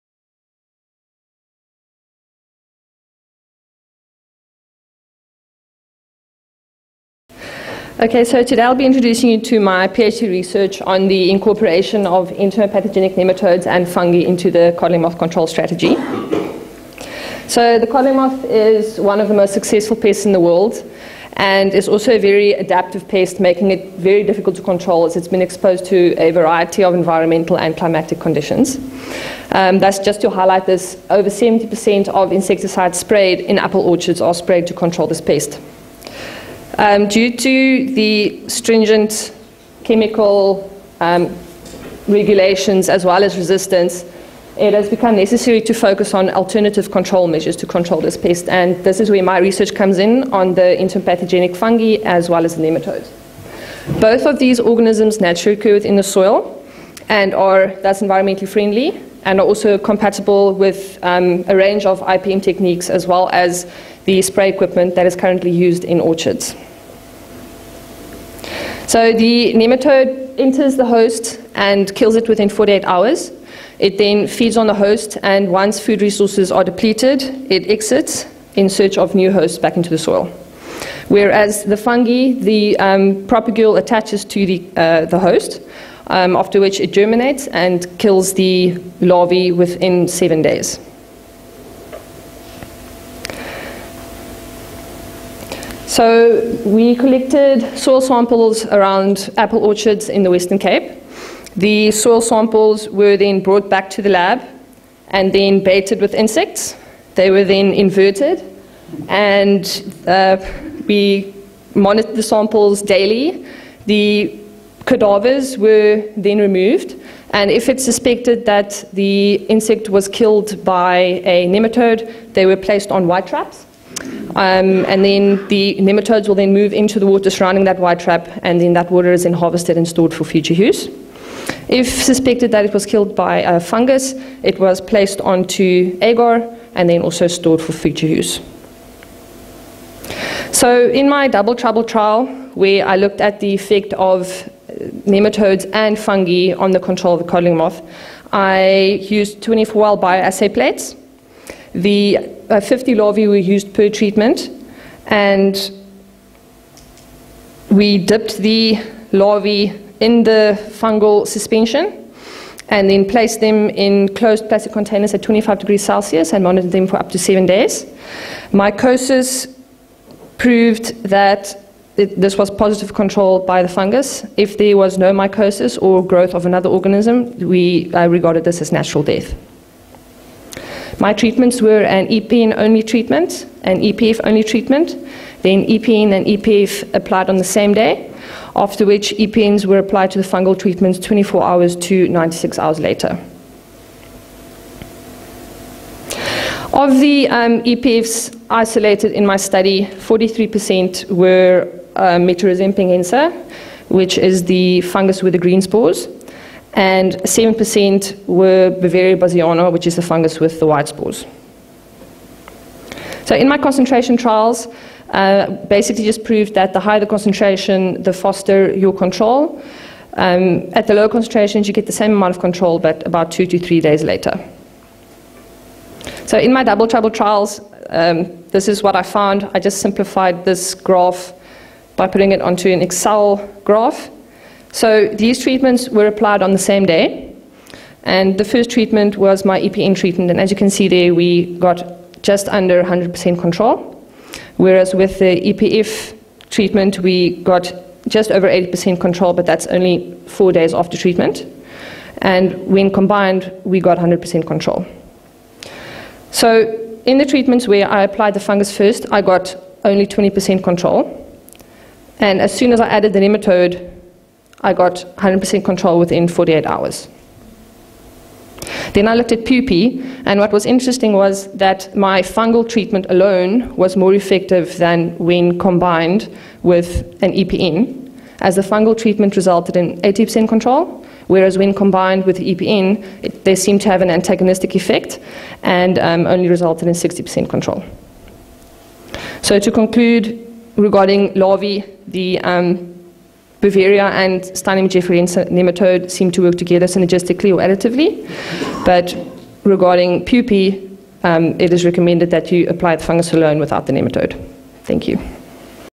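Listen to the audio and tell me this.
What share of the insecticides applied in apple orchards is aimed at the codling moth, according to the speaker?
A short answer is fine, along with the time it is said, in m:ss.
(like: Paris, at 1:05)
over 70%, at 0:31.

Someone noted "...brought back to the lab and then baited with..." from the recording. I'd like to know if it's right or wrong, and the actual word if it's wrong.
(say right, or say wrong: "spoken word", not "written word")
right.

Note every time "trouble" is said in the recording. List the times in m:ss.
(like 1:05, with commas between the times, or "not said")
2:21, 3:46.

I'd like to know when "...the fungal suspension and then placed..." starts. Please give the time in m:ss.
2:40.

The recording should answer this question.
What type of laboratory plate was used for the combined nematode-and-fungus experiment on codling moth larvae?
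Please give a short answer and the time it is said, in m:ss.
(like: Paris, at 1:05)
24 well bioassay plates, at 2:29.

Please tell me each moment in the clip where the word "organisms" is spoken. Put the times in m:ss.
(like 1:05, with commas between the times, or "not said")
0:54, 2:56.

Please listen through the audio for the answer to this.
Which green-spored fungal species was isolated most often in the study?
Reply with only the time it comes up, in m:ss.
3:22.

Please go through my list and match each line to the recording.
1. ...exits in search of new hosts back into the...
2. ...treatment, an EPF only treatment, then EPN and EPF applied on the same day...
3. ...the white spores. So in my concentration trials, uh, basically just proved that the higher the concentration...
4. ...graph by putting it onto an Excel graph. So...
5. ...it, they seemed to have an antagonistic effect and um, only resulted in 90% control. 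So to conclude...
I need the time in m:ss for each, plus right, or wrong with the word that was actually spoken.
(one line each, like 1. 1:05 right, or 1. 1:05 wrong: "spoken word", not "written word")
1. 1:17 right
2. 3:02 right
3. 3:30 right
4. 3:50 right
5. 4:43 wrong: "60", not "90".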